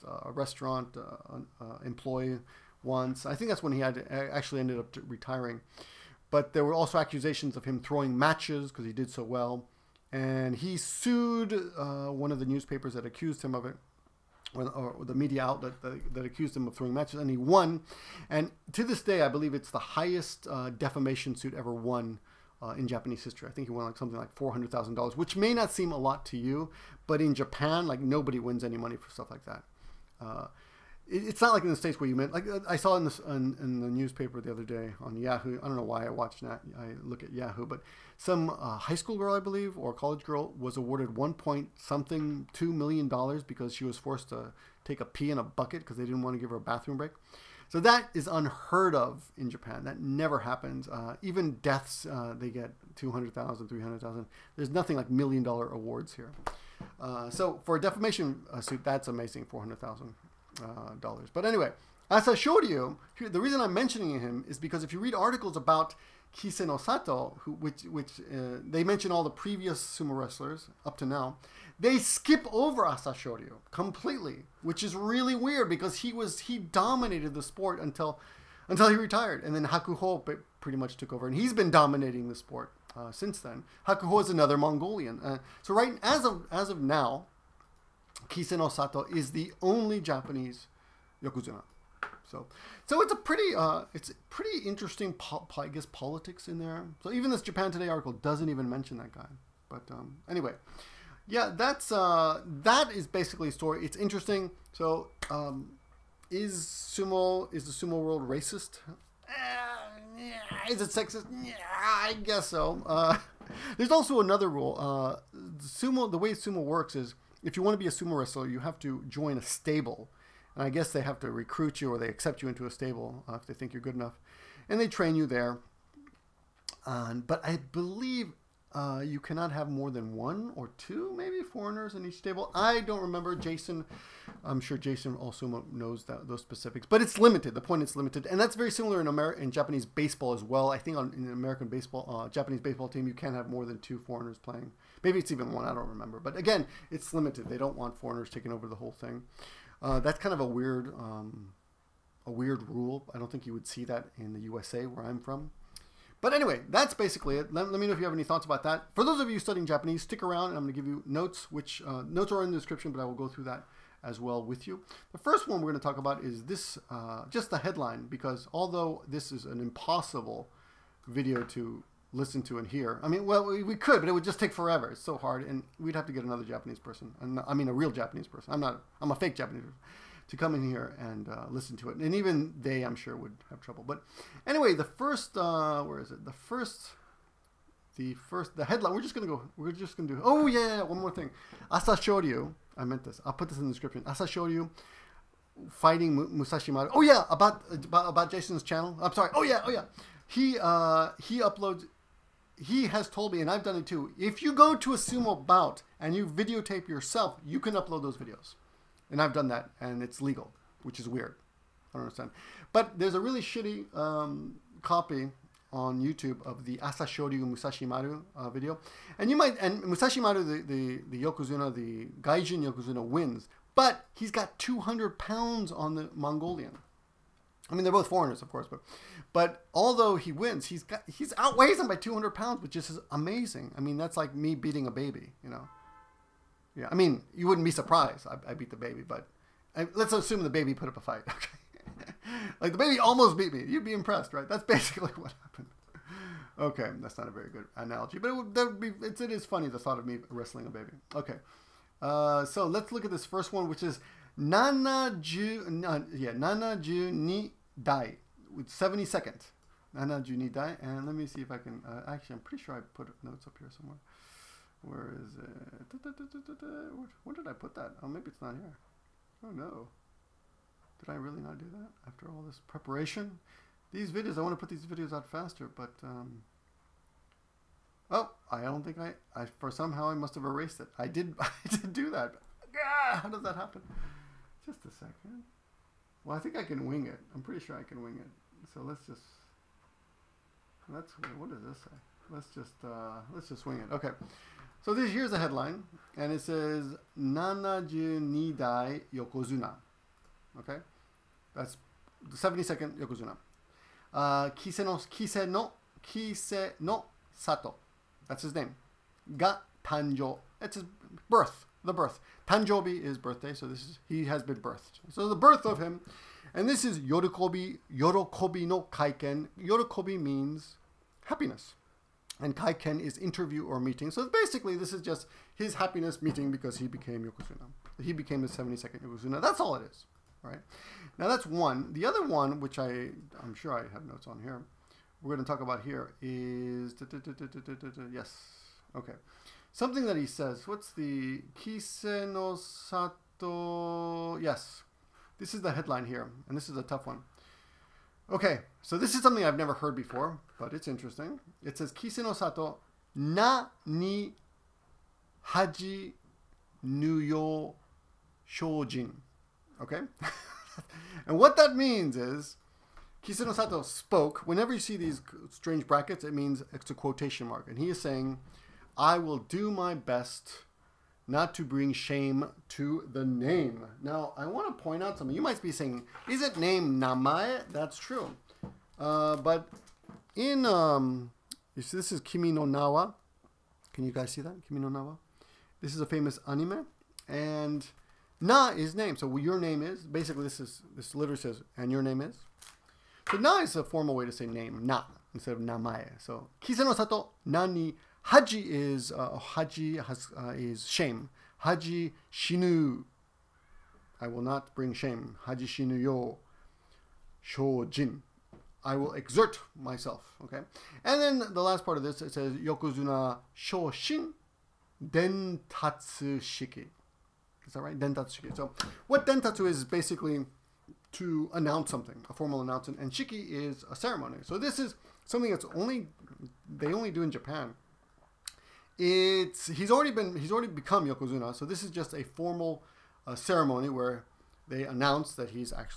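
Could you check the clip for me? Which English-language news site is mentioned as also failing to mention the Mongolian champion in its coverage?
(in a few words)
Japan Today.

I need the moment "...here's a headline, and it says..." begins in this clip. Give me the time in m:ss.
4:55.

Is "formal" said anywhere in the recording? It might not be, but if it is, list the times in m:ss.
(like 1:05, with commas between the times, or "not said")
6:33, 7:02, 7:12.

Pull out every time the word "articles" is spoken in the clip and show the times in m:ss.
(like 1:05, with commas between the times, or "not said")
1:05, 1:37.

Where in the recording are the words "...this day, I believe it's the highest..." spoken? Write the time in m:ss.
0:18.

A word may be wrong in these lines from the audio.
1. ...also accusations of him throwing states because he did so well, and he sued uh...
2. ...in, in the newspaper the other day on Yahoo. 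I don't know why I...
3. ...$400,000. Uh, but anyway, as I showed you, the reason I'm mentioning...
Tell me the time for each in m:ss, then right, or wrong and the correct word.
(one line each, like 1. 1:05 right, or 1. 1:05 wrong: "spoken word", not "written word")
1. 0:06 wrong: "matches", not "states"
2. 0:33 right
3. 0:59 right.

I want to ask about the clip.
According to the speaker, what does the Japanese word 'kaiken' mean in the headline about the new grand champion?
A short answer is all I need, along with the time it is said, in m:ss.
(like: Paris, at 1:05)
interview or meeting, at 5:23.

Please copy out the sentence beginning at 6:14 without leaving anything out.
Now, I want to point out something.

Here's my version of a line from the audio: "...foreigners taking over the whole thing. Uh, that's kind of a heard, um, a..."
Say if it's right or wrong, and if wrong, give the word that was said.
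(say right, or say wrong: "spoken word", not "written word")
wrong: "weird", not "heard".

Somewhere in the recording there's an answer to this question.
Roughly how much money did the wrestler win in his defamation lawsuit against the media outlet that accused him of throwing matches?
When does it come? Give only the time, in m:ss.
0:24.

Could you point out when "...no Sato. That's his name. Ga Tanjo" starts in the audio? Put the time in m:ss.
5:06.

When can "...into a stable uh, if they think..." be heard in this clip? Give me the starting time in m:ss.
2:02.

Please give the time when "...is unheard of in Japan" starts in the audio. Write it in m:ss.
0:48.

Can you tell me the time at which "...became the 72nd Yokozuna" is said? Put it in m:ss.
5:28.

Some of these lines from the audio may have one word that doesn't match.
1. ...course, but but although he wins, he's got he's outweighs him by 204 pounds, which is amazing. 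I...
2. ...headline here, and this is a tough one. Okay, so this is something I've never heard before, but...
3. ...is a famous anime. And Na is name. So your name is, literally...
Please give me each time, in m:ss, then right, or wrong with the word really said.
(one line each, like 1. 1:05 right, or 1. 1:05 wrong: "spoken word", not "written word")
1. 3:48 wrong: "200", not "204"
2. 5:45 right
3. 6:25 wrong: "basically", not "literally".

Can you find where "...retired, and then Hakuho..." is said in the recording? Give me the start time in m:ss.
1:18.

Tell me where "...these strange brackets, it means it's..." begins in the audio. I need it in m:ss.
6:04.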